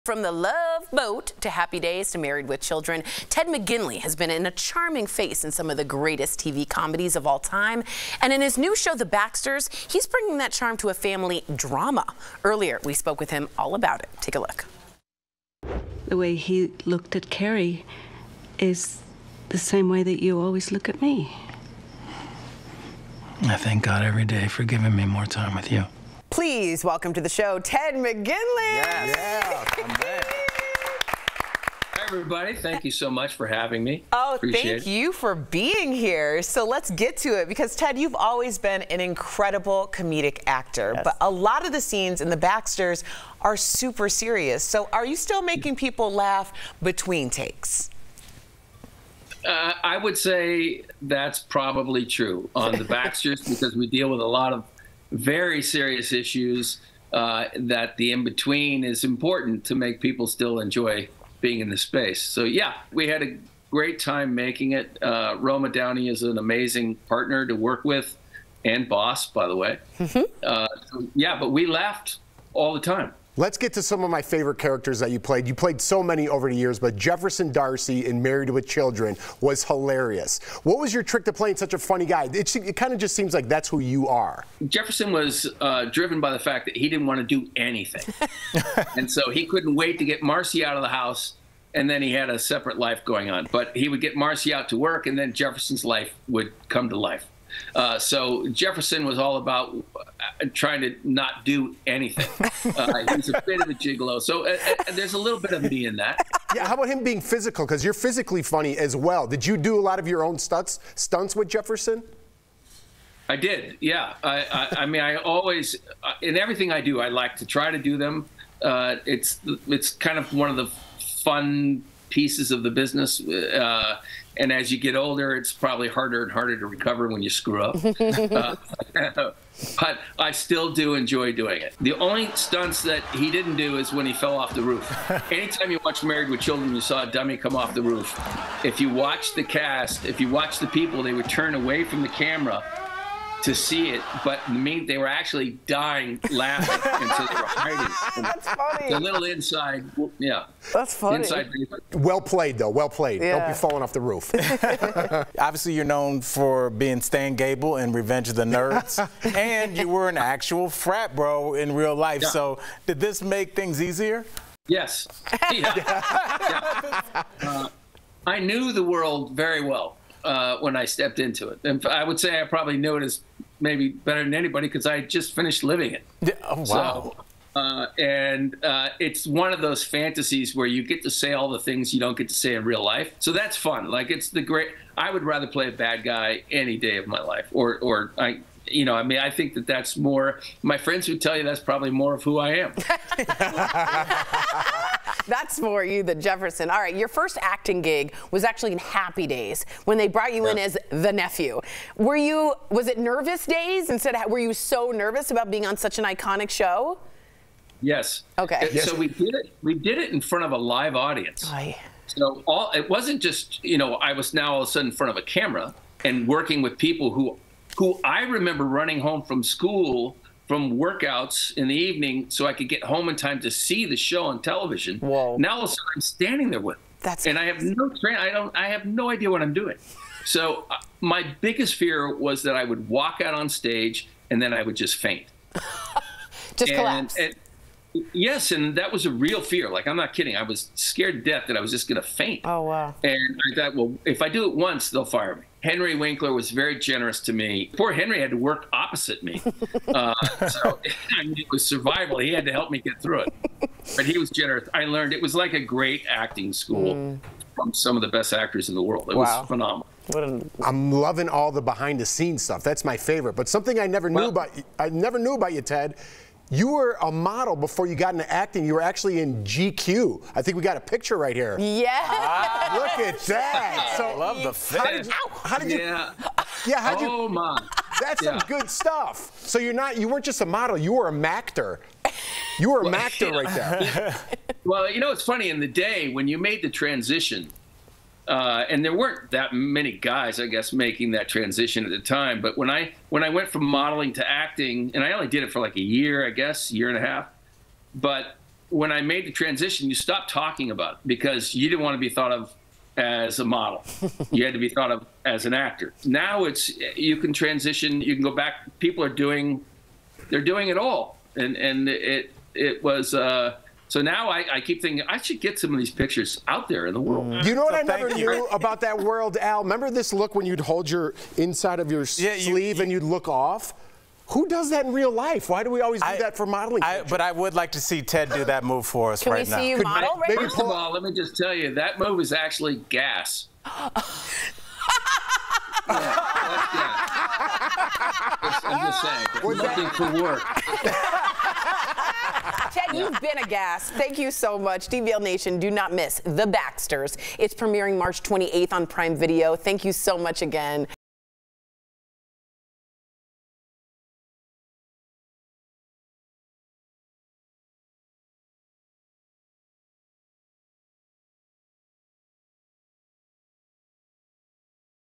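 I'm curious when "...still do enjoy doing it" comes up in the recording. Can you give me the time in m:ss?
2:10.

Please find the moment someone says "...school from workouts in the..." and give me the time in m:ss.
3:39.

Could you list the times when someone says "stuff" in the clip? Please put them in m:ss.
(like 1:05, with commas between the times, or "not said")
4:22, 4:38.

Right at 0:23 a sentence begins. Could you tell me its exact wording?
I thank God every day for giving me more time with you please welcome to the show Ted McGinley.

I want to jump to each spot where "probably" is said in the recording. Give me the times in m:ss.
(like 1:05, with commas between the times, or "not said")
0:51, 2:05, 2:52, 3:11.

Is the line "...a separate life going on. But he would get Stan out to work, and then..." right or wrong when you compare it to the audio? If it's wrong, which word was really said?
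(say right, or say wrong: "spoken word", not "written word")
wrong: "Marcy", not "Stan".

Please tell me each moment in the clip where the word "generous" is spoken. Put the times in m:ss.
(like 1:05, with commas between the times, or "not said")
4:06, 4:14.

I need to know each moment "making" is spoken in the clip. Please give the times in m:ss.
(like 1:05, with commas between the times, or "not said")
0:45, 1:04, 4:50.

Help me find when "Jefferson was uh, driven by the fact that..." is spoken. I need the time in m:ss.
1:24.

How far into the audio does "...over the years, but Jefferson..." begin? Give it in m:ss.
1:16.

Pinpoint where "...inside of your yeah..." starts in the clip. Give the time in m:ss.
5:21.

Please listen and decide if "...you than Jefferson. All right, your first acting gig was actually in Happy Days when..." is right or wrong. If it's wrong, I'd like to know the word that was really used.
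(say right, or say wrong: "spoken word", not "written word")
right.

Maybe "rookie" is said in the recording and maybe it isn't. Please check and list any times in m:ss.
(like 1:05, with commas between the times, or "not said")
not said.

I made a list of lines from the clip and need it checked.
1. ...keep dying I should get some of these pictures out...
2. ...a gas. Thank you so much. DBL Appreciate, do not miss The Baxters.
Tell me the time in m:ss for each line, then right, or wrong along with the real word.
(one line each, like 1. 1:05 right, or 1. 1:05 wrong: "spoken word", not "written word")
1. 5:14 wrong: "thinking", not "dying"
2. 5:43 wrong: "Nation", not "Appreciate".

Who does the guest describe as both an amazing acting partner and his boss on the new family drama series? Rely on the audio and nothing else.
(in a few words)
Roma Downey.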